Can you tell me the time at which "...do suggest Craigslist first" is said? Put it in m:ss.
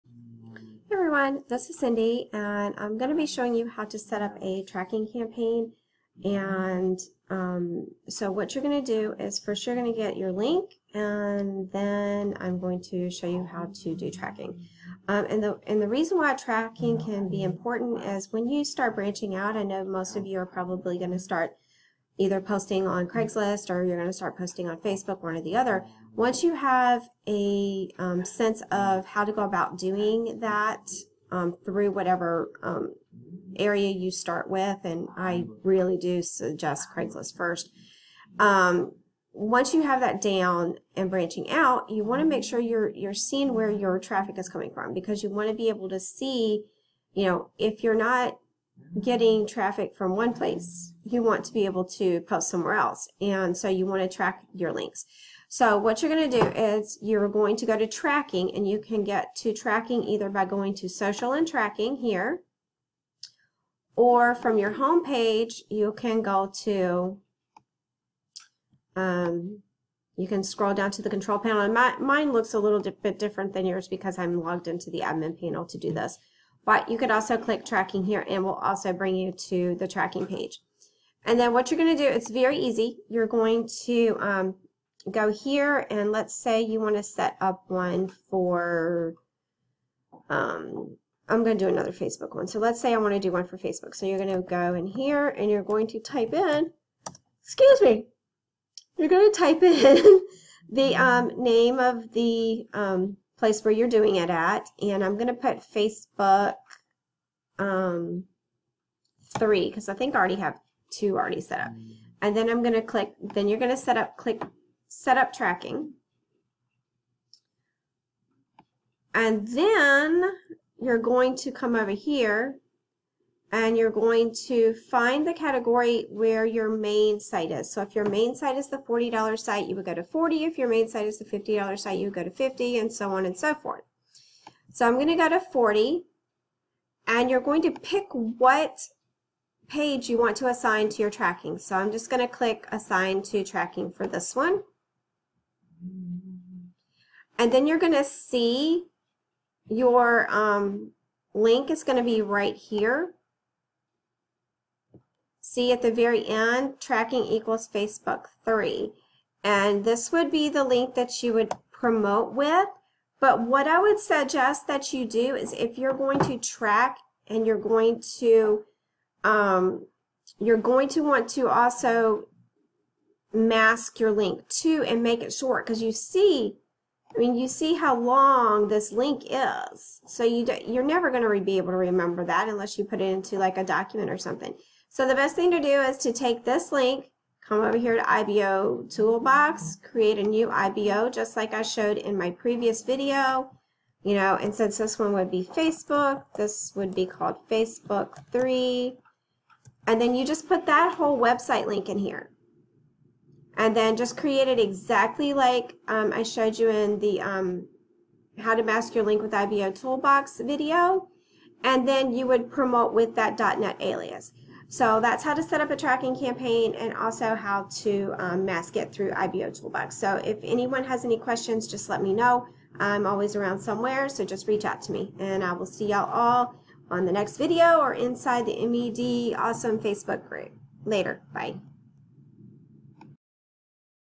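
0:35.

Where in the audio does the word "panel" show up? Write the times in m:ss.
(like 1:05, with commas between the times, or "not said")
1:11, 1:15.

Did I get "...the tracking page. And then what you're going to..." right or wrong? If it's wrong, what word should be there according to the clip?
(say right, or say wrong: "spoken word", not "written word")
right.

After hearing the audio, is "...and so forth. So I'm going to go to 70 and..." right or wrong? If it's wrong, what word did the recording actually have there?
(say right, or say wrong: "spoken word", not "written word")
wrong: "40", not "70".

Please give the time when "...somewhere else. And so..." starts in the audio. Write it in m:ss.
0:52.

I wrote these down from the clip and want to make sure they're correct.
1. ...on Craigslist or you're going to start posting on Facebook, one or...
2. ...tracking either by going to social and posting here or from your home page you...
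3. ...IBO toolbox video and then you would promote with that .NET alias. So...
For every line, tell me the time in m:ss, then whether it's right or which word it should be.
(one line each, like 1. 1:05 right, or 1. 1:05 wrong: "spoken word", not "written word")
1. 0:22 right
2. 0:59 wrong: "tracking", not "posting"
3. 3:29 right.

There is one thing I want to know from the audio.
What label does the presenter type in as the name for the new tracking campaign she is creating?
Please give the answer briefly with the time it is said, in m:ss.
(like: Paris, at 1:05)
Facebook 3, at 1:45.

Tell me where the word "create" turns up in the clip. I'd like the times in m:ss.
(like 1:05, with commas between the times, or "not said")
3:09, 3:24.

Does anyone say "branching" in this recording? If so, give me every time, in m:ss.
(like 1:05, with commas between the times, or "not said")
0:18, 0:41.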